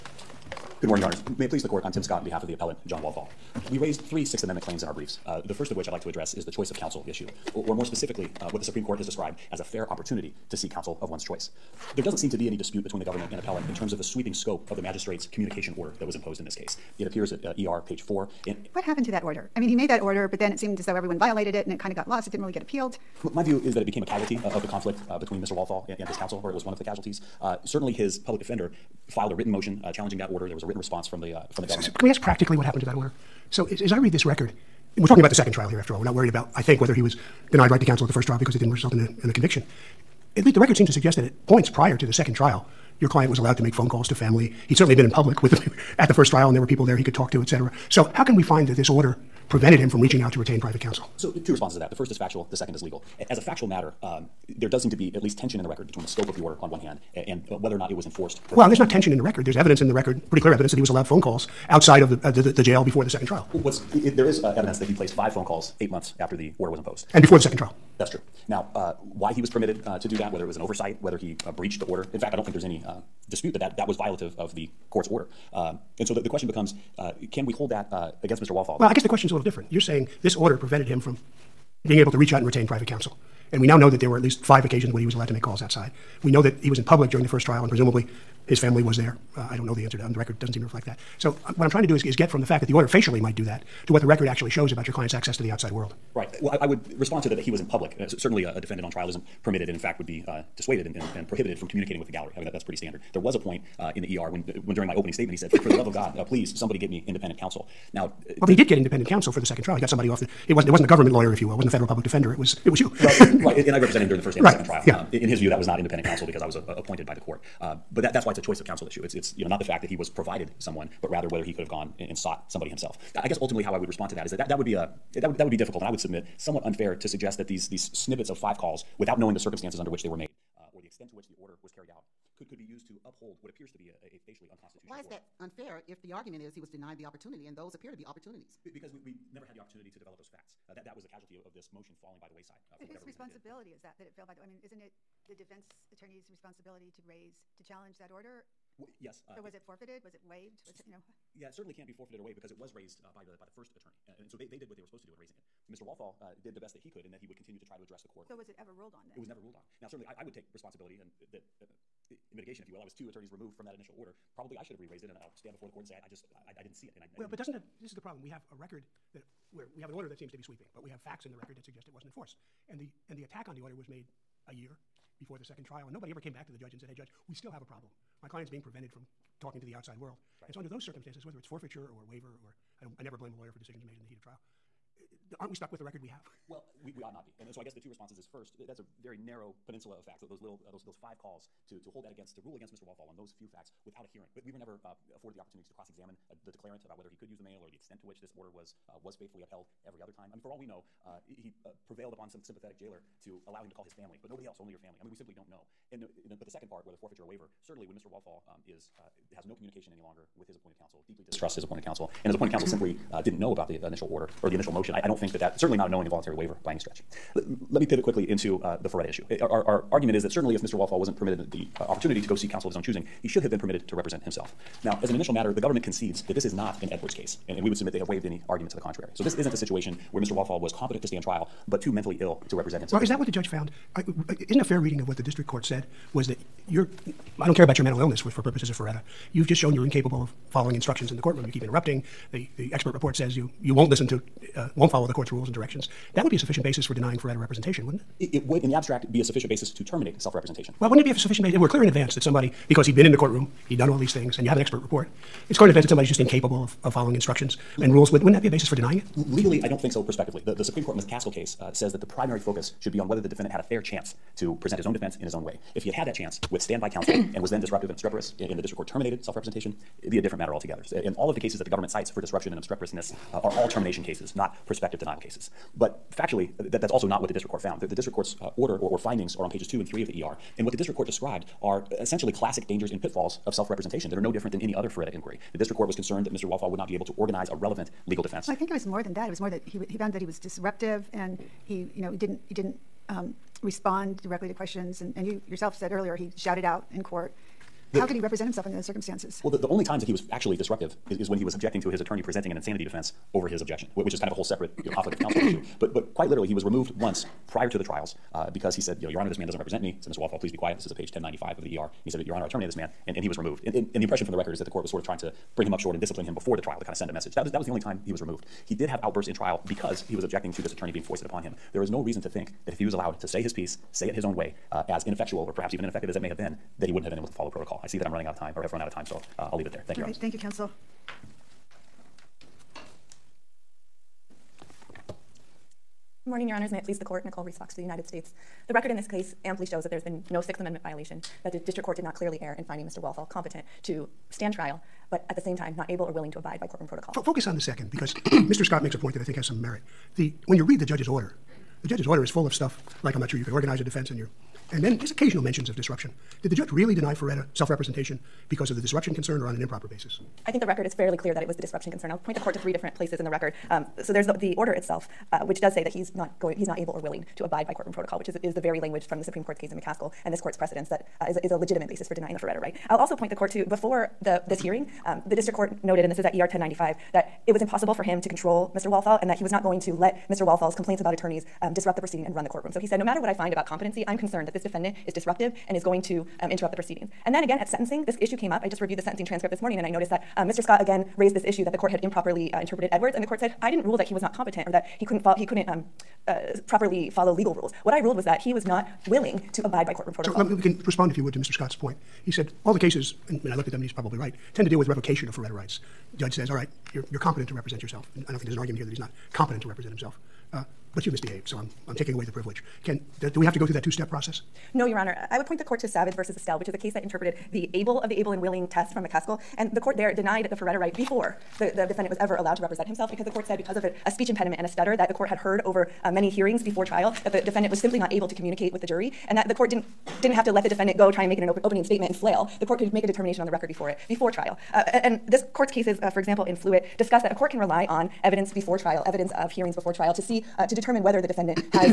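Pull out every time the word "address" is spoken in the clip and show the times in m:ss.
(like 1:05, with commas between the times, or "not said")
0:06, 2:37.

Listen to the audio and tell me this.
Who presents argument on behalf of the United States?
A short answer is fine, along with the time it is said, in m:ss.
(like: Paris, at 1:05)
Nicole Reese Fox, at 5:37.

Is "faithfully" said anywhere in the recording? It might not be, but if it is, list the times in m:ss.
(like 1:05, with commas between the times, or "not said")
3:19.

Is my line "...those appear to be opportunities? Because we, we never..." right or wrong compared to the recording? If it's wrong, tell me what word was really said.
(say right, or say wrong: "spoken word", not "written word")
right.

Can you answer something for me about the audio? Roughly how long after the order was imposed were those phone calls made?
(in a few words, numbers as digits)
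eight months.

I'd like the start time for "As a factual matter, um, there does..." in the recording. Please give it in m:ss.
0:53.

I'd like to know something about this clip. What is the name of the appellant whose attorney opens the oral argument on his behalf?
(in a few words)
John Walthall.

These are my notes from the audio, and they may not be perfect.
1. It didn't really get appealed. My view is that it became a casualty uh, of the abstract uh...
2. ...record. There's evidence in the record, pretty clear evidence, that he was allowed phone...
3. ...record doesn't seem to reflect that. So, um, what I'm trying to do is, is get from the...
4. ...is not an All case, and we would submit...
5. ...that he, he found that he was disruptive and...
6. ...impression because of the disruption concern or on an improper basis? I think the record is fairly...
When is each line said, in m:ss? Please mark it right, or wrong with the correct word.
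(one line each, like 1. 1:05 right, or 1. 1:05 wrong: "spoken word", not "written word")
1. 0:22 wrong: "conflict", not "abstract"
2. 0:59 right
3. 1:30 right
4. 3:46 wrong: "Edwards", not "All"
5. 4:49 right
6. 5:57 wrong: "representation", not "impression".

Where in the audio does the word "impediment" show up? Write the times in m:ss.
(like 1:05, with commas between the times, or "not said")
7:04.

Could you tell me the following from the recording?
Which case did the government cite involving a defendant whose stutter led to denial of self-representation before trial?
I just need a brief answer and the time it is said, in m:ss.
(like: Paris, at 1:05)
Savage versus Estelle, at 6:55.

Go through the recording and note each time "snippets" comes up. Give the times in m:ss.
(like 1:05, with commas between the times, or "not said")
2:07.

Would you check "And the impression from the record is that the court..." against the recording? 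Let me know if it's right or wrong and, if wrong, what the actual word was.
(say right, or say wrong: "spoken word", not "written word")
right.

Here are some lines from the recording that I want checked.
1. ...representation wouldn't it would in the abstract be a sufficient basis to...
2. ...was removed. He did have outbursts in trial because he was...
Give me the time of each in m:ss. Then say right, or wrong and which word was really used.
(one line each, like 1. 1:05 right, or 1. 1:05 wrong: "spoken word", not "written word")
1. 4:07 right
2. 5:18 right.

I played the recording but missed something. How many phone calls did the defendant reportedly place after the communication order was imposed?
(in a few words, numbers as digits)
5.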